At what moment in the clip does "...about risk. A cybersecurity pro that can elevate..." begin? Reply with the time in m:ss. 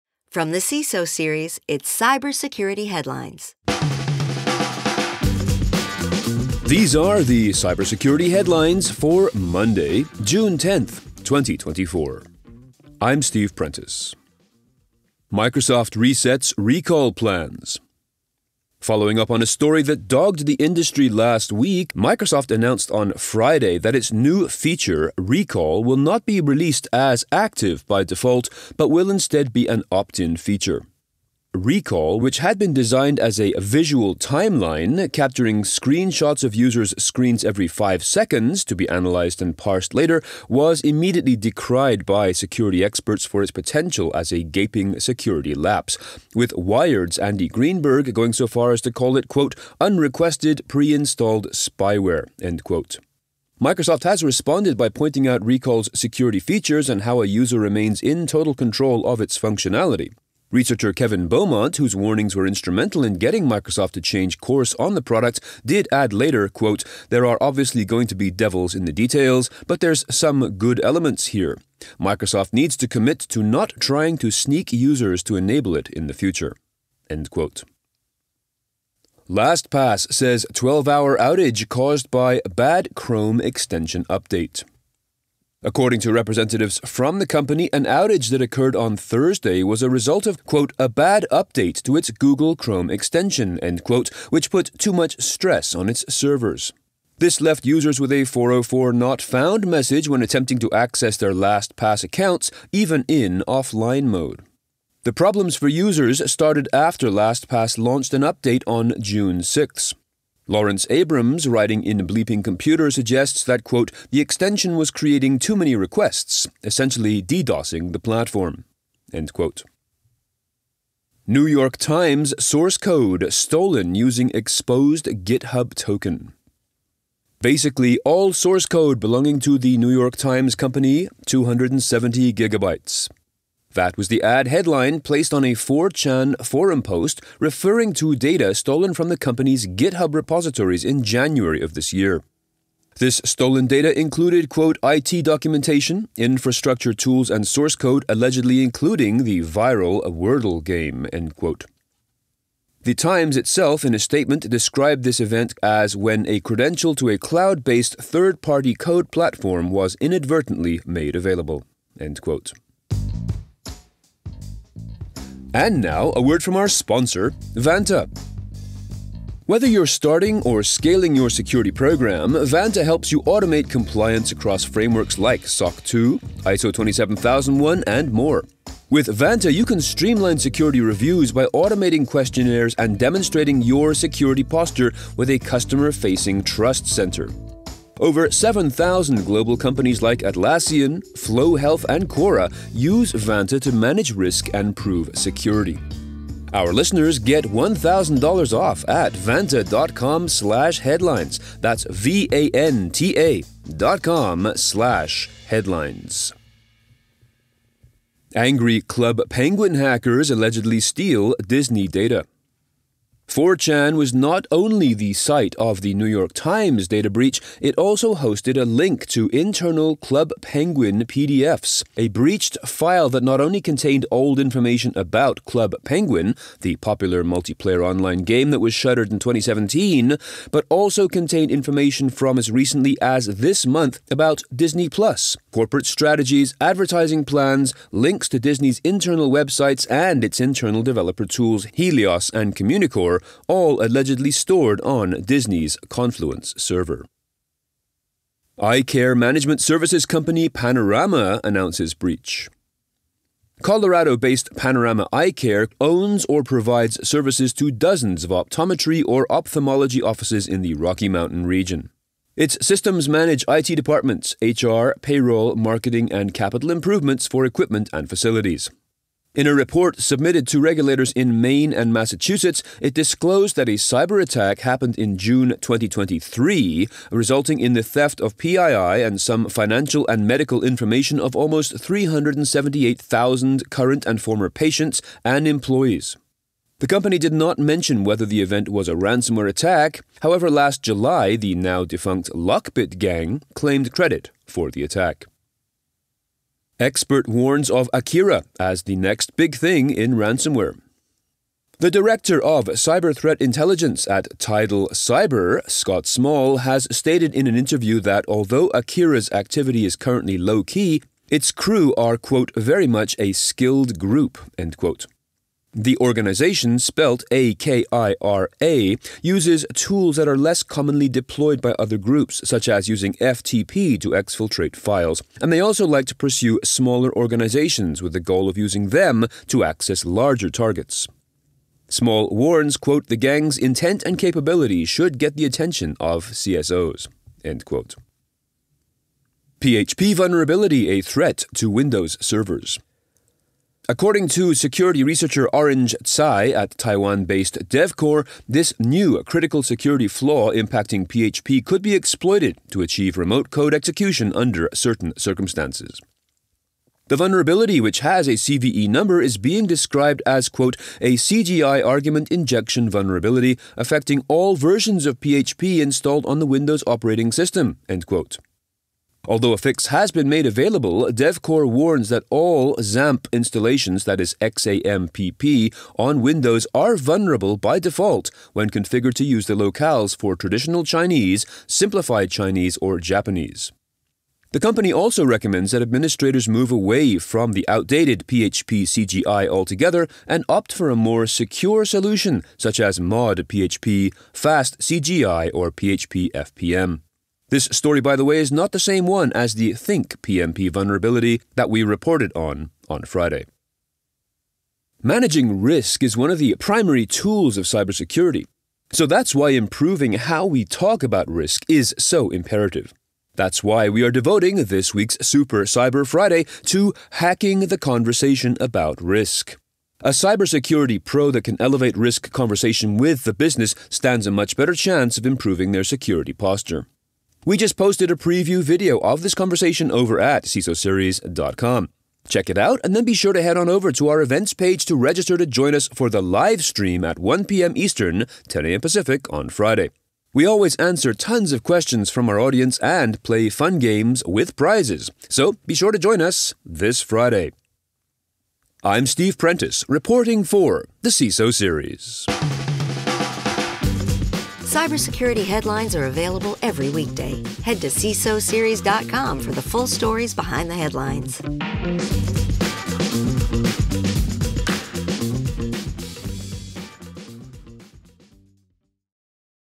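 6:58.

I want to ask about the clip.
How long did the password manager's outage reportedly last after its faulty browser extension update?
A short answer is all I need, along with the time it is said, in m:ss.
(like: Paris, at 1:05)
12 hours, at 1:20.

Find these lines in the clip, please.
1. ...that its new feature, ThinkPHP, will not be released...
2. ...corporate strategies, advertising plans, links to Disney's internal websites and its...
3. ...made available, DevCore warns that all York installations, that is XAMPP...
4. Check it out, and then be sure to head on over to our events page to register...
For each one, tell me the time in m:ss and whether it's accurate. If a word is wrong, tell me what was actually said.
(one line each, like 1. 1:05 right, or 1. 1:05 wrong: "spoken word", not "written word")
1. 0:23 wrong: "Recall", not "ThinkPHP"
2. 3:55 right
3. 6:10 wrong: "XAMPP", not "York"
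4. 7:12 right.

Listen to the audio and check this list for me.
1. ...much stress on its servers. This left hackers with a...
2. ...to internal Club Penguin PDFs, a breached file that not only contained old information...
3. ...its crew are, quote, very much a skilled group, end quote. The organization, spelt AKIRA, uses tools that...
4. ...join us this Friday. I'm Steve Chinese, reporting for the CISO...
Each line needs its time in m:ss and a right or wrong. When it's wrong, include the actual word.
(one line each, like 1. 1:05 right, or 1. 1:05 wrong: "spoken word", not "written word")
1. 1:34 wrong: "users", not "hackers"
2. 3:39 right
3. 5:11 right
4. 7:25 wrong: "Prentice", not "Chinese".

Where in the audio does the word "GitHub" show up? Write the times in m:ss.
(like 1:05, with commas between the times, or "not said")
2:05, 2:19.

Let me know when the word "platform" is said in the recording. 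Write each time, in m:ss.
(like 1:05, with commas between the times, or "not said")
1:57, 2:39.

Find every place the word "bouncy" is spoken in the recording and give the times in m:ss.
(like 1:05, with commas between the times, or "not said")
not said.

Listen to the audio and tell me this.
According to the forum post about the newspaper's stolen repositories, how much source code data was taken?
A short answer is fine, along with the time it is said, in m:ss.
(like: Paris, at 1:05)
270 gigabytes, at 2:11.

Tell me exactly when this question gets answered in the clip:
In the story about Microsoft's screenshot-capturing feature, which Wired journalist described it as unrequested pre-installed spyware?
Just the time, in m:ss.
0:47.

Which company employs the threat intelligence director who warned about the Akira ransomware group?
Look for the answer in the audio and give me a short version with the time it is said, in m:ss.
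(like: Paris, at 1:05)
Tidal Cyber, at 5:04.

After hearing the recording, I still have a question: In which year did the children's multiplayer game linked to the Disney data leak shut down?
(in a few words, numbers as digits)
2017.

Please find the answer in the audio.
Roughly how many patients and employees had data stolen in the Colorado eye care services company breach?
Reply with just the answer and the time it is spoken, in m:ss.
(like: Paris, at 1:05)
378,000, at 4:41.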